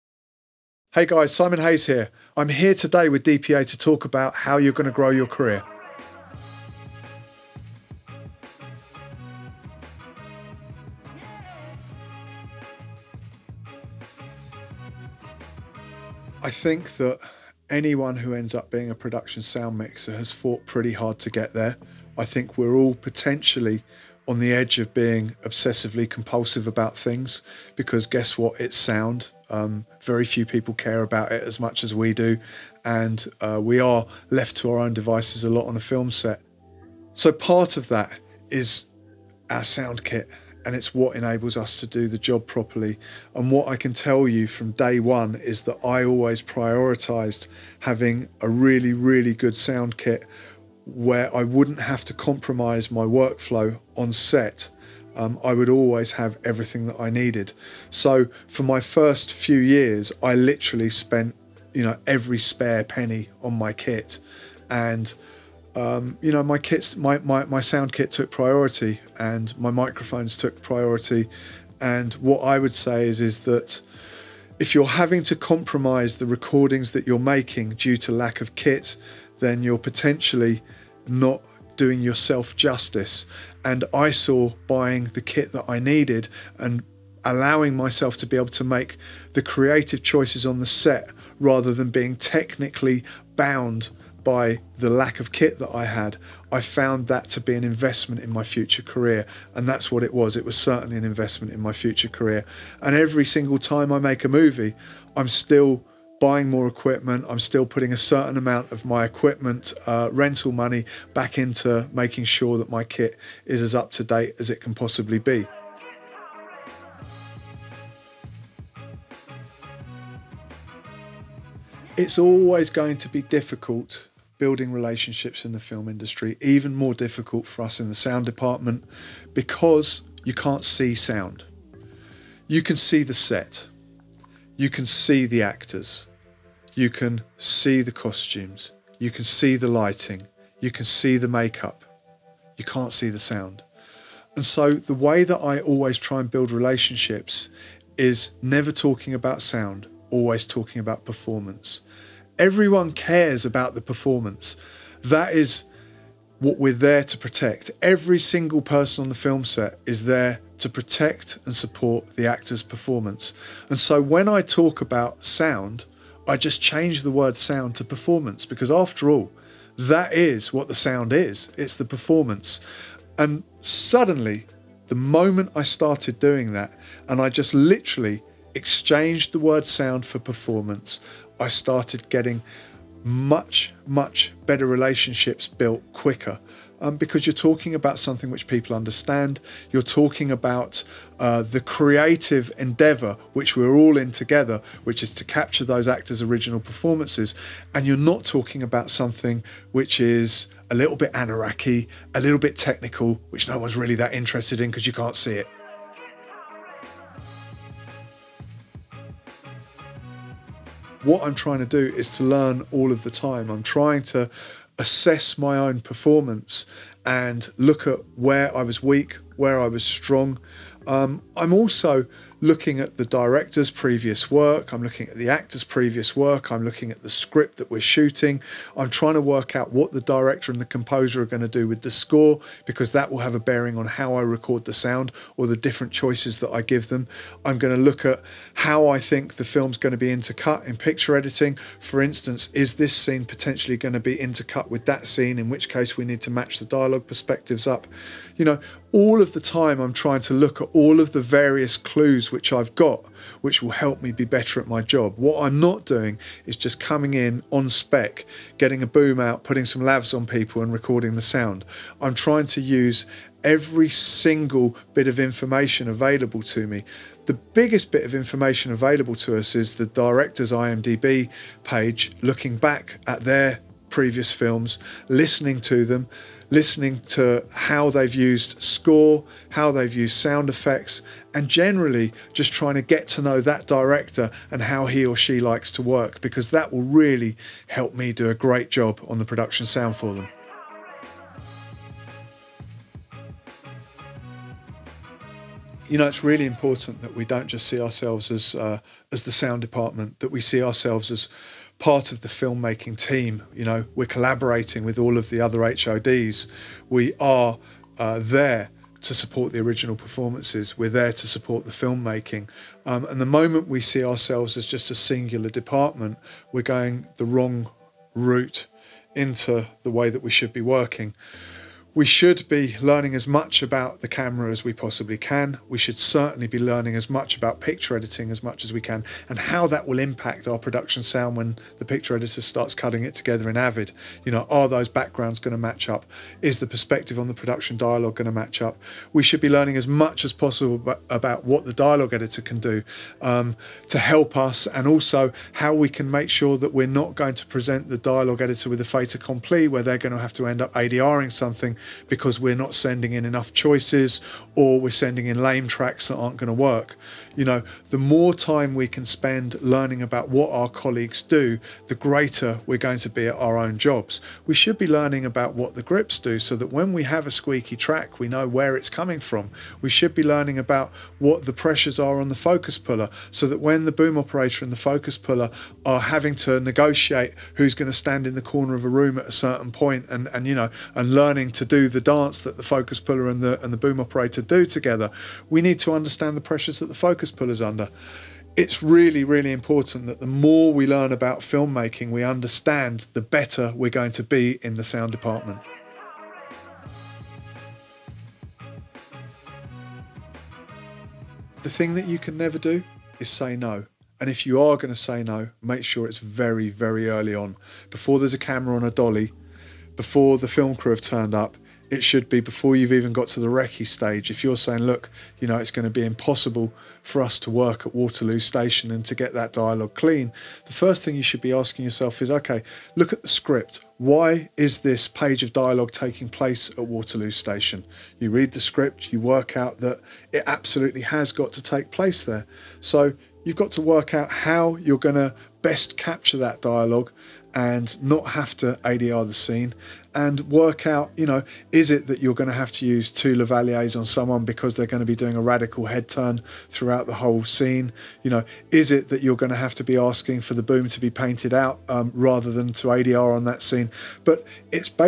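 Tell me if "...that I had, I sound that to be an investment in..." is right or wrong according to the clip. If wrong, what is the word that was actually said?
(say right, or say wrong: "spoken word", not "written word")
wrong: "found", not "sound".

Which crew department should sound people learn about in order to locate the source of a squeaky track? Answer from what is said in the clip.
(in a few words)
the grips.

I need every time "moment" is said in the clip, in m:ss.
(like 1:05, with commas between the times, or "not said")
2:54, 5:13.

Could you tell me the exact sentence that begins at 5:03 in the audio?
You know, we're collaborating with all of the other HODs.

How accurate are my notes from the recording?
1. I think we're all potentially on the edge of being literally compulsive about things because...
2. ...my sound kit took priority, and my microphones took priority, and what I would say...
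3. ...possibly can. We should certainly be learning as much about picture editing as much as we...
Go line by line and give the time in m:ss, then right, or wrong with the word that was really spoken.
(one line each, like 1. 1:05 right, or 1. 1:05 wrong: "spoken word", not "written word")
1. 0:22 wrong: "obsessively", not "literally"
2. 1:07 right
3. 5:24 right.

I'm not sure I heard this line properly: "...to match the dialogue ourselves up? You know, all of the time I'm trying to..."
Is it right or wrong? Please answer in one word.
wrong.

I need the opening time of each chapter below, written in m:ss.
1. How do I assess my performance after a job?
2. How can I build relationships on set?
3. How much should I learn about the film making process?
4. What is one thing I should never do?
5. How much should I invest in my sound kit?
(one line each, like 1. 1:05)
1. 3:25
2. 1:56
3. 4:51
4. 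6:36
5. 0:11.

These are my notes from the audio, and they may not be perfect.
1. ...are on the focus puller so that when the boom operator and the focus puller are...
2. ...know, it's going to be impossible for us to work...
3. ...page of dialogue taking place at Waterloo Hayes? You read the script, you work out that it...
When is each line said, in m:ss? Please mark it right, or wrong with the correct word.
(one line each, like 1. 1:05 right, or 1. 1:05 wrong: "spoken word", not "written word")
1. 6:11 right
2. 6:55 right
3. 7:05 wrong: "Station", not "Hayes".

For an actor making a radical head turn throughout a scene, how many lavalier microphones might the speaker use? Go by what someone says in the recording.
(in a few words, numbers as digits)
2.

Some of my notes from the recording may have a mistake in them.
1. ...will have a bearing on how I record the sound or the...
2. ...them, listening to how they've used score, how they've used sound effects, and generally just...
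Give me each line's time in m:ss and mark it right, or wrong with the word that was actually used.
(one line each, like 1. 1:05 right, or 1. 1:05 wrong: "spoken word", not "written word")
1. 3:53 right
2. 4:35 right.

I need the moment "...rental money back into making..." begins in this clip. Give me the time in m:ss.
1:50.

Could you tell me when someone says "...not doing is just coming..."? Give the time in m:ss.
4:15.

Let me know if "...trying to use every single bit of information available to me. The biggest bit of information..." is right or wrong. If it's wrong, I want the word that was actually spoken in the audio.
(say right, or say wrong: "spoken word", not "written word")
right.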